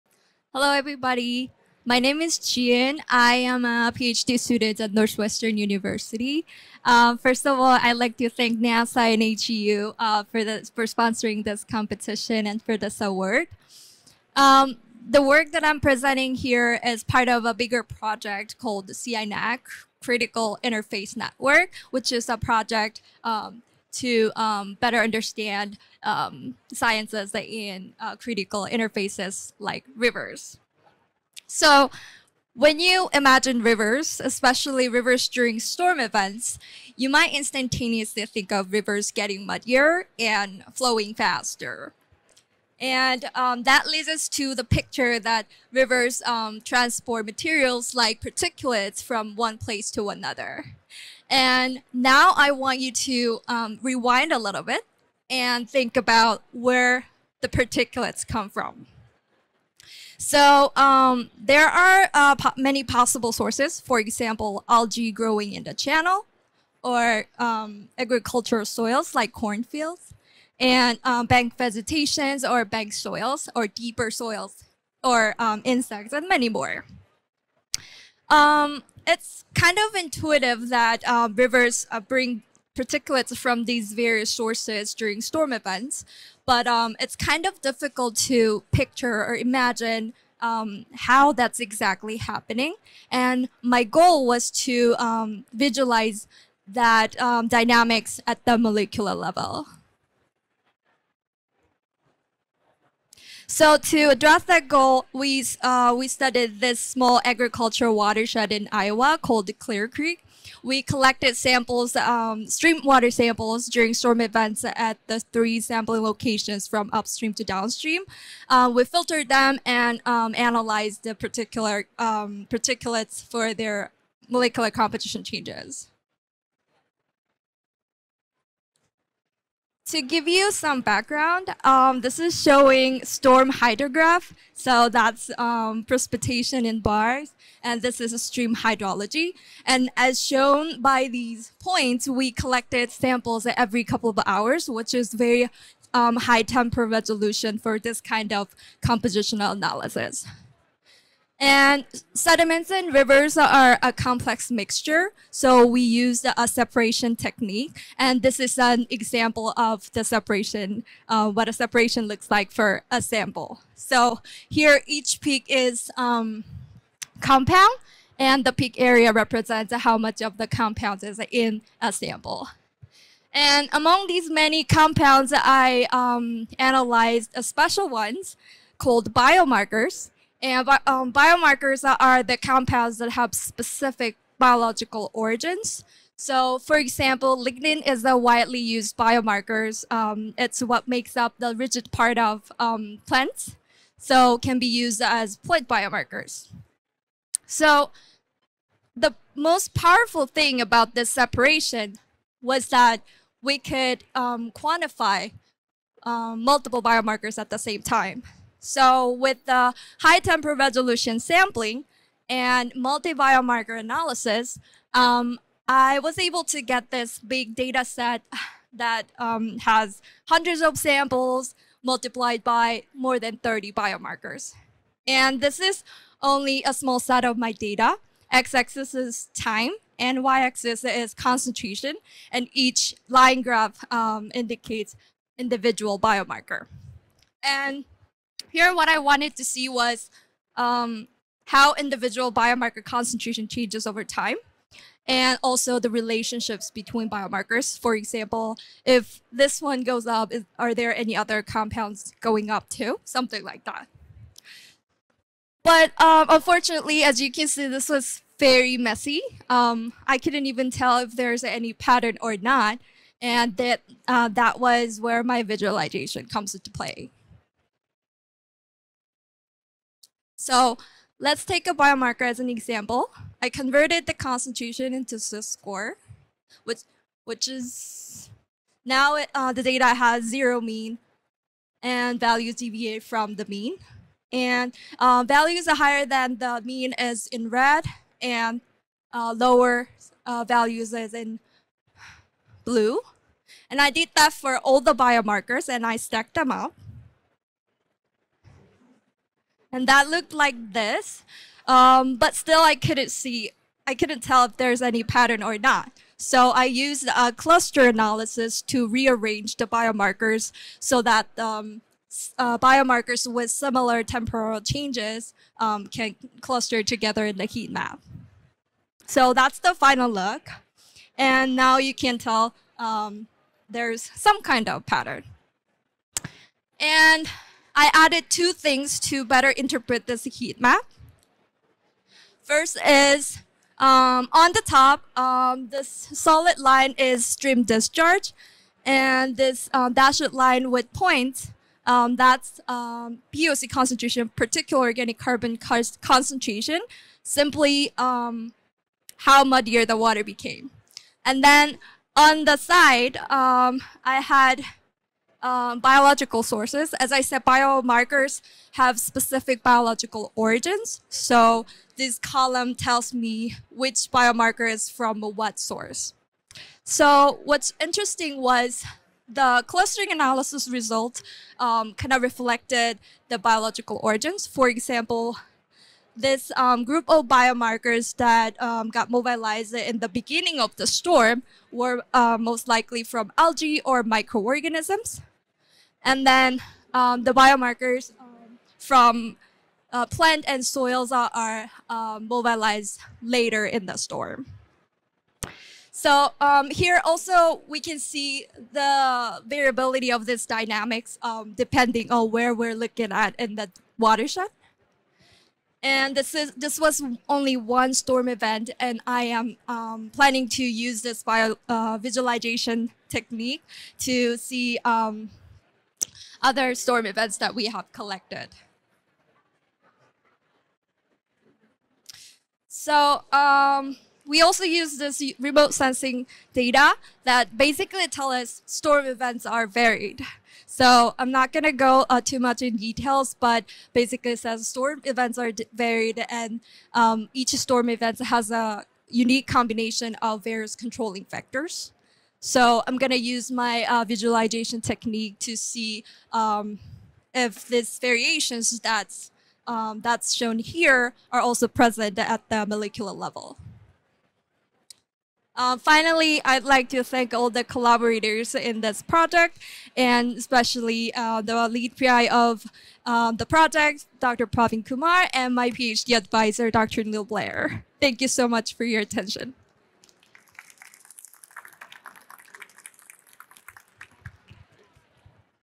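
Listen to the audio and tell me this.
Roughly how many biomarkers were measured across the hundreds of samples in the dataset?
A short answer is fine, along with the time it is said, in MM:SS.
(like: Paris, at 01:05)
more than 30, at 03:42.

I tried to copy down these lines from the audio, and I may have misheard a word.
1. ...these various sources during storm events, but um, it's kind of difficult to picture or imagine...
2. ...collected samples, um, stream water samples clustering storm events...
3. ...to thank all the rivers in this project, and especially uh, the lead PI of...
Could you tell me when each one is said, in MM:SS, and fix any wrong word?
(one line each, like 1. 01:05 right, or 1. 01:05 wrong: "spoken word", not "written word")
1. 01:23 right
2. 01:50 wrong: "during", not "clustering"
3. 07:36 wrong: "collaborators", not "rivers".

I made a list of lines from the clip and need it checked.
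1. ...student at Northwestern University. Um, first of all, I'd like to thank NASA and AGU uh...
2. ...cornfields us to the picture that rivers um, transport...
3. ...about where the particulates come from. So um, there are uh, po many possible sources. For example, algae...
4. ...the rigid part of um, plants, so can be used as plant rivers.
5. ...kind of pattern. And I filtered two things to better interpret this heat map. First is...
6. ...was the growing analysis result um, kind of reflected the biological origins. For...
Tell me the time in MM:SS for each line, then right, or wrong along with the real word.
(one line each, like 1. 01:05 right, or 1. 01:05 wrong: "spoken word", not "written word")
1. 00:04 right
2. 00:43 wrong: "leads", not "cornfields"
3. 00:55 right
4. 03:11 wrong: "biomarkers", not "rivers"
5. 05:24 wrong: "added", not "filtered"
6. 06:08 wrong: "clustering", not "growing".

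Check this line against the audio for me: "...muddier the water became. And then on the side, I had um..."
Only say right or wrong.
right.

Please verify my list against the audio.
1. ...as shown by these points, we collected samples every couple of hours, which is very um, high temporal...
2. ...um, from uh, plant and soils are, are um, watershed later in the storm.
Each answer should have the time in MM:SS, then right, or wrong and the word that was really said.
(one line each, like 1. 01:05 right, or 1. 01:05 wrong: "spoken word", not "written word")
1. 02:19 right
2. 06:28 wrong: "mobilized", not "watershed".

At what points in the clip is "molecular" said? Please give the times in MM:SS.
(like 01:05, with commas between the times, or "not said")
01:38, 02:04, 07:32.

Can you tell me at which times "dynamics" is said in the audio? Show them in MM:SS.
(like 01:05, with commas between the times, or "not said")
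01:37, 06:40.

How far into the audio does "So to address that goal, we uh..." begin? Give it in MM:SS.
01:43.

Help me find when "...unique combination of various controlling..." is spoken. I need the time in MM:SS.
07:19.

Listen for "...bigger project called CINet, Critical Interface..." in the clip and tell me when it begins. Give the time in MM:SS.
00:17.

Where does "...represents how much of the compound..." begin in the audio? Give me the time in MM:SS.
02:49.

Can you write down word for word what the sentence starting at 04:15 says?
But um, unfortunately, as you can see, this was very messy.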